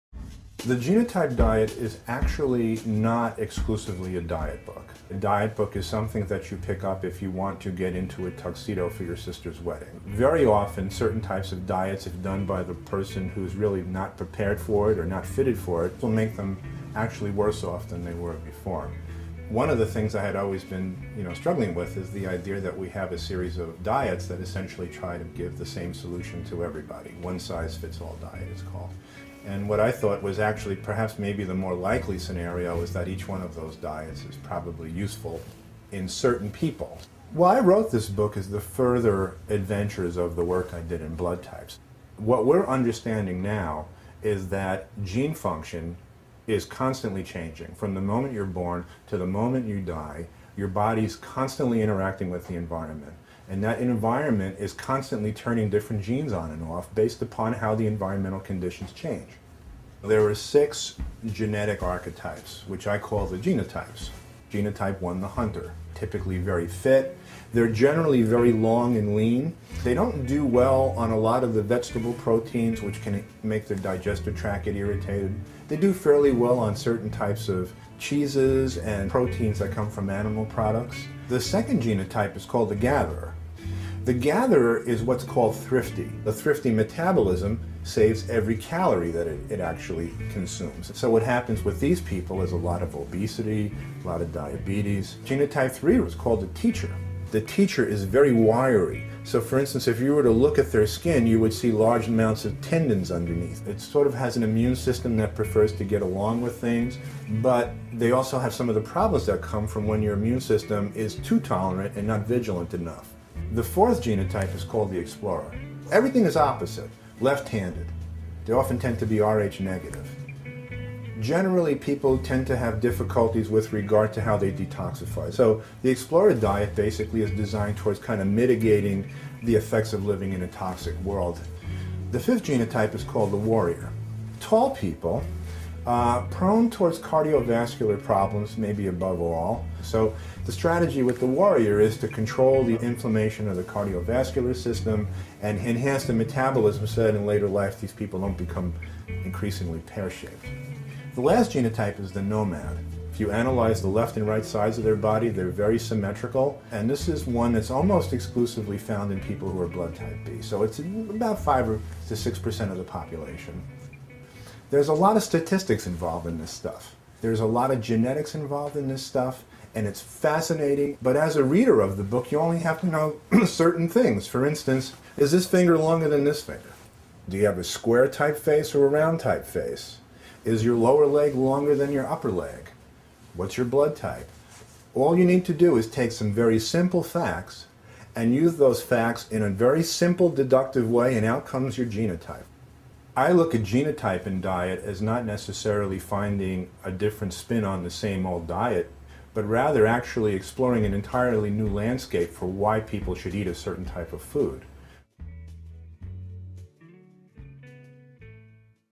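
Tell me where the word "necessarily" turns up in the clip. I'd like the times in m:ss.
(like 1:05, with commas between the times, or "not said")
3:15.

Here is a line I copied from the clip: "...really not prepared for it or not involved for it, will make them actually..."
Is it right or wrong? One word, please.
wrong.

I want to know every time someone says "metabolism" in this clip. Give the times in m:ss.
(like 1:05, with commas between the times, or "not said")
1:26, 2:26.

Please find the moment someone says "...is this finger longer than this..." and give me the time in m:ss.
2:55.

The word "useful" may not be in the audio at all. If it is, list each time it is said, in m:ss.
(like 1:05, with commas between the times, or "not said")
0:34.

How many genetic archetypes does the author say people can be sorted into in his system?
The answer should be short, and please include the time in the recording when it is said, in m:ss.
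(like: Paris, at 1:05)
6, at 1:00.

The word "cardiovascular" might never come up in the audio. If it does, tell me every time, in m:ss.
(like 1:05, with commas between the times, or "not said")
2:16, 2:23.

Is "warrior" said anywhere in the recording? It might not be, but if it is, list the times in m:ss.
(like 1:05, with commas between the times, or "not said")
2:13, 2:21.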